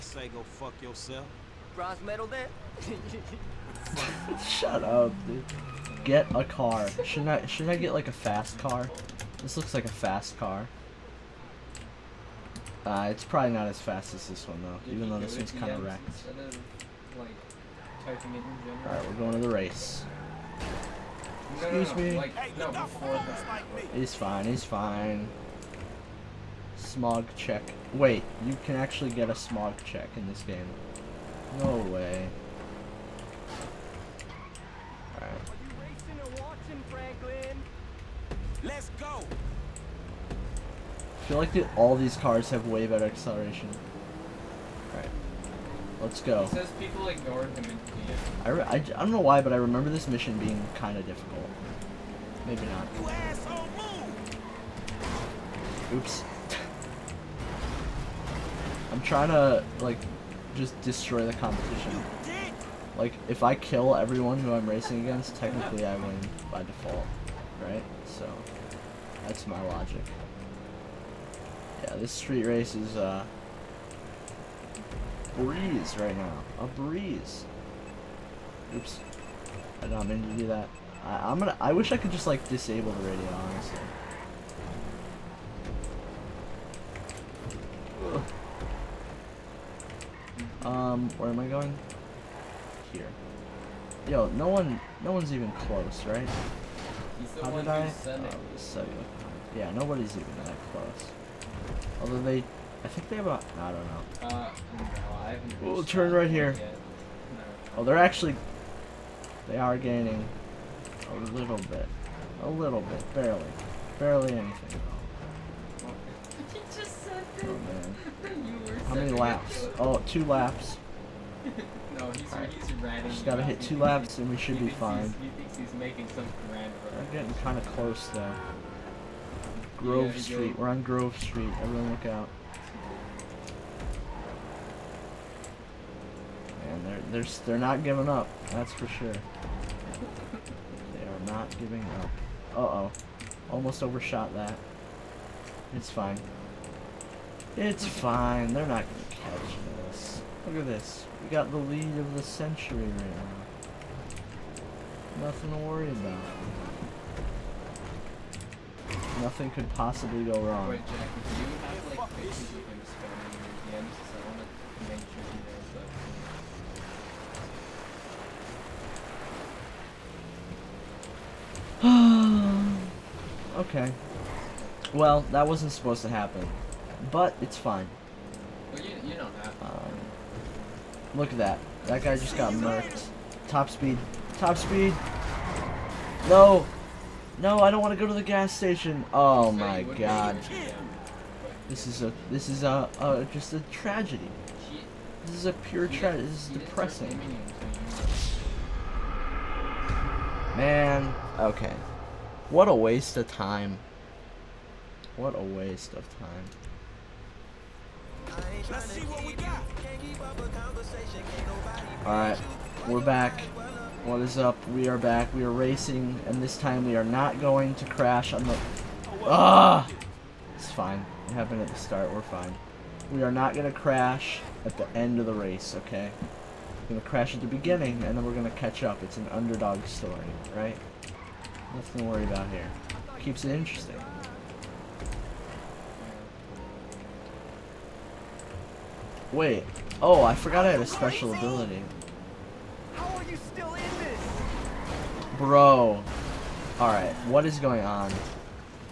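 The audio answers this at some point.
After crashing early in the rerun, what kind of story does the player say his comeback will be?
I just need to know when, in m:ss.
3:49.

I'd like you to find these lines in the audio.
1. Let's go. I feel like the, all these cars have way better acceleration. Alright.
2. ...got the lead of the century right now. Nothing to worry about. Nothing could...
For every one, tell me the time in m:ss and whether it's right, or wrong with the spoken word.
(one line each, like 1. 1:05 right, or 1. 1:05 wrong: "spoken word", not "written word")
1. 0:38 right
2. 2:31 right.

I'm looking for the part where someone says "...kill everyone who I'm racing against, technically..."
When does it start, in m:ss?
1:03.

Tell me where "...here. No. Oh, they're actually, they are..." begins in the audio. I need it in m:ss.
1:46.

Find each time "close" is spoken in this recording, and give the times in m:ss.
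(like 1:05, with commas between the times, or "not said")
1:35, 1:40, 2:07.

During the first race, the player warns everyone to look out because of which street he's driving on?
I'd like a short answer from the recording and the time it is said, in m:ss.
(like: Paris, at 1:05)
Grove Street, at 2:10.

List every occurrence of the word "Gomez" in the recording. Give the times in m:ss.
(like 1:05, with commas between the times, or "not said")
not said.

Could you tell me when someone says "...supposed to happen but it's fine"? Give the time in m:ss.
2:55.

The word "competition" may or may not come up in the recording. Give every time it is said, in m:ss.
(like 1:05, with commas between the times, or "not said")
1:01.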